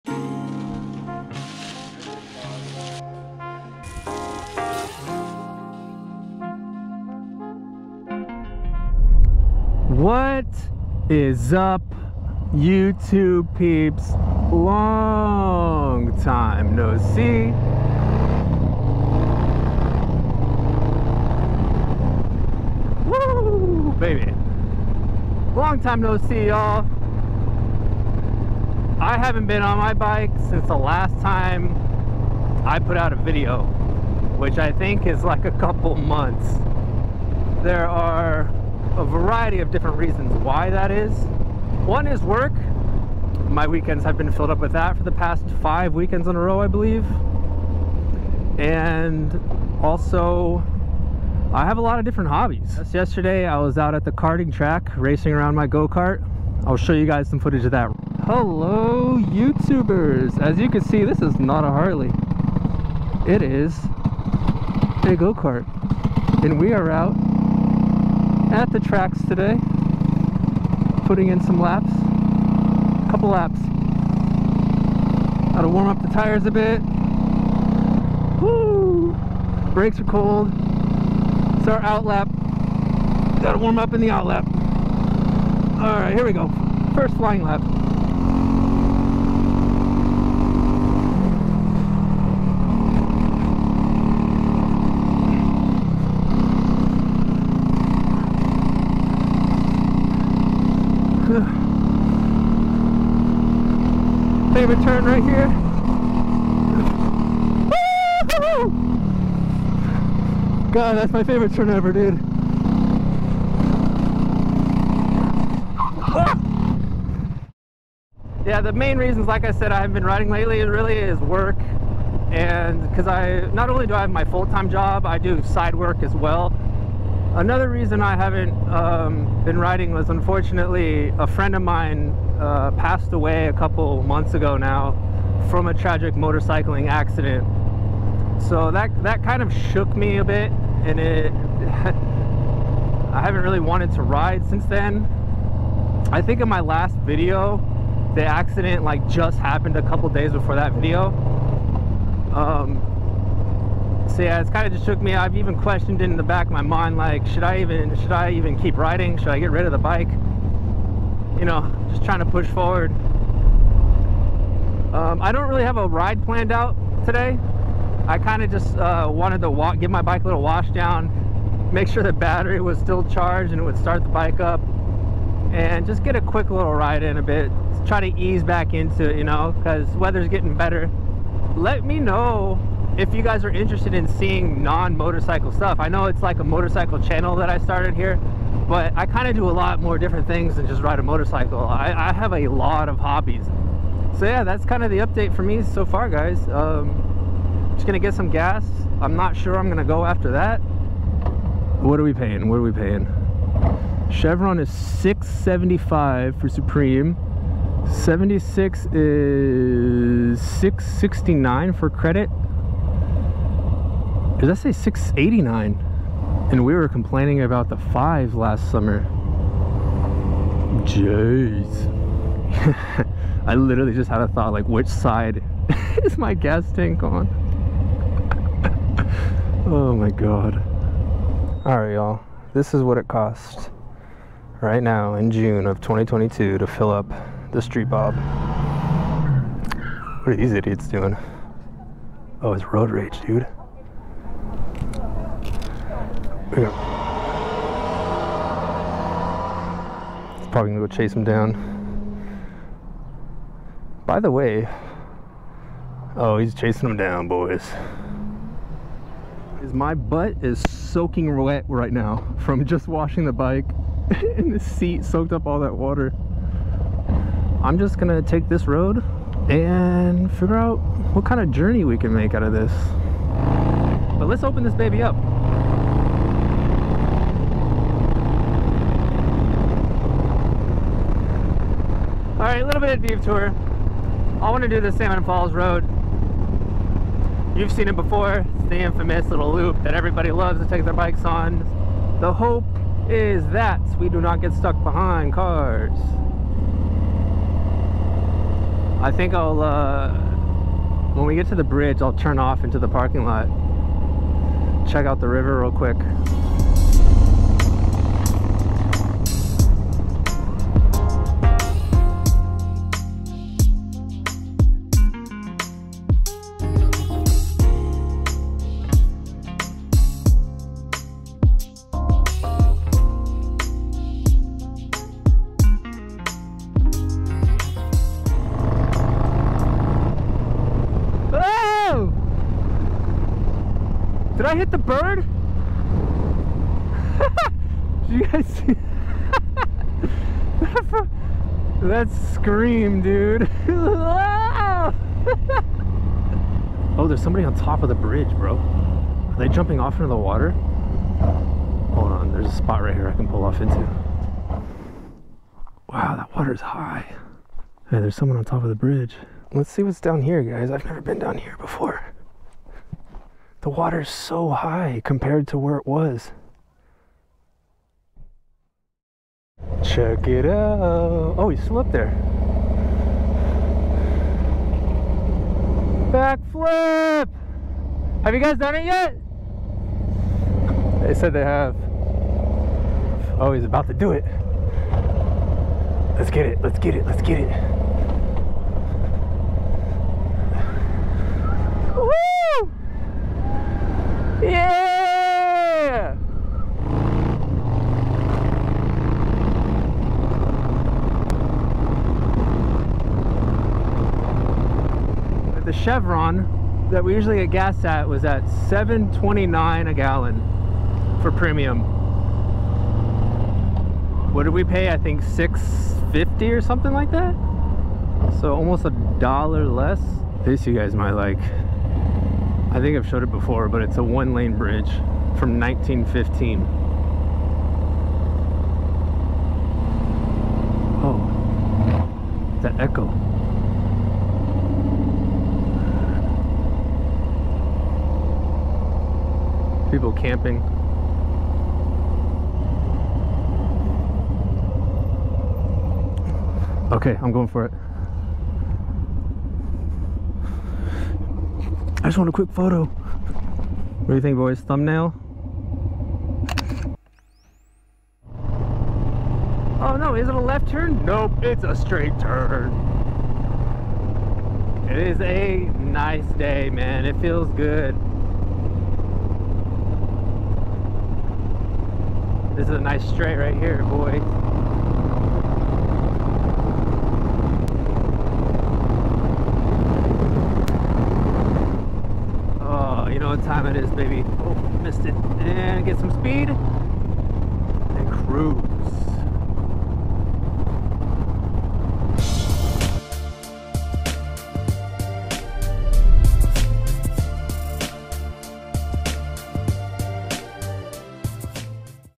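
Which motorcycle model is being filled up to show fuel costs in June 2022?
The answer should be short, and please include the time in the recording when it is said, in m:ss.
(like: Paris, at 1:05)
Street Bob, at 3:57.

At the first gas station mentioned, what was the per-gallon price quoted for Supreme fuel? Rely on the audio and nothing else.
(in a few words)
6.75.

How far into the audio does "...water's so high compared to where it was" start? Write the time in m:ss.
6:03.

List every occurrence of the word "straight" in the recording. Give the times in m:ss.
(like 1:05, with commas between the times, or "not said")
7:41, 7:53.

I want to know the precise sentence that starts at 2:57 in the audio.
Try to ease back into it, you know, because weather's getting better.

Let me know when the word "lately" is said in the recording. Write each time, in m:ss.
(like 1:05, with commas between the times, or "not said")
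2:00.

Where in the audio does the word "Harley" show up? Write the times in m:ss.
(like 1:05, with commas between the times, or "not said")
1:01.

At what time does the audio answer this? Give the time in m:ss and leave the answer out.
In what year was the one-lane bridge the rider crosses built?
7:05.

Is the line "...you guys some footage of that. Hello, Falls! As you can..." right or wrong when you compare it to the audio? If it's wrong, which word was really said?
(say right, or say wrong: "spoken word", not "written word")
wrong: "YouTubers", not "Falls".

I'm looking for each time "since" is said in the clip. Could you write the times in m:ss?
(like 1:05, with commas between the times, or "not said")
0:30, 2:24.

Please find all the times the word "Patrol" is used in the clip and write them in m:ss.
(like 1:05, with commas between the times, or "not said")
not said.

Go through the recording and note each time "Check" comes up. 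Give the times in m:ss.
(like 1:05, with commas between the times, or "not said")
5:04, 6:09.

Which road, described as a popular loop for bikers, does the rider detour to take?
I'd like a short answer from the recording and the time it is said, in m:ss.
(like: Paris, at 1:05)
Salmon Falls Road, at 4:44.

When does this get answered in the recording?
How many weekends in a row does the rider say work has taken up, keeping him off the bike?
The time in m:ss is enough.
0:45.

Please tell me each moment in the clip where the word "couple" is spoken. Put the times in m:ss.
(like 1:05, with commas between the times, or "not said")
0:35, 1:13, 2:13, 2:29.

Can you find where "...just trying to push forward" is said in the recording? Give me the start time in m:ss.
2:41.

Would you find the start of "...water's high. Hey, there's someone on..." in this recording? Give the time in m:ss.
5:56.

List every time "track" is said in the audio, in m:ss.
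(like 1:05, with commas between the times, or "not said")
0:54, 1:08.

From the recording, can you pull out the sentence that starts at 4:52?
The hope is that we do not get stuck behind cars.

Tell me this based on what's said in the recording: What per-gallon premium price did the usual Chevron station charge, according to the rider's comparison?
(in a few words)
7.29.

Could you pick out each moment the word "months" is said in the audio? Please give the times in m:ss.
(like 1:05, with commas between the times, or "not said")
0:35, 2:14.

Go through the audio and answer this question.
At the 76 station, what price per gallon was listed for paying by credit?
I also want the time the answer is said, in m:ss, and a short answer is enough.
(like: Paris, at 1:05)
6.69, at 3:30.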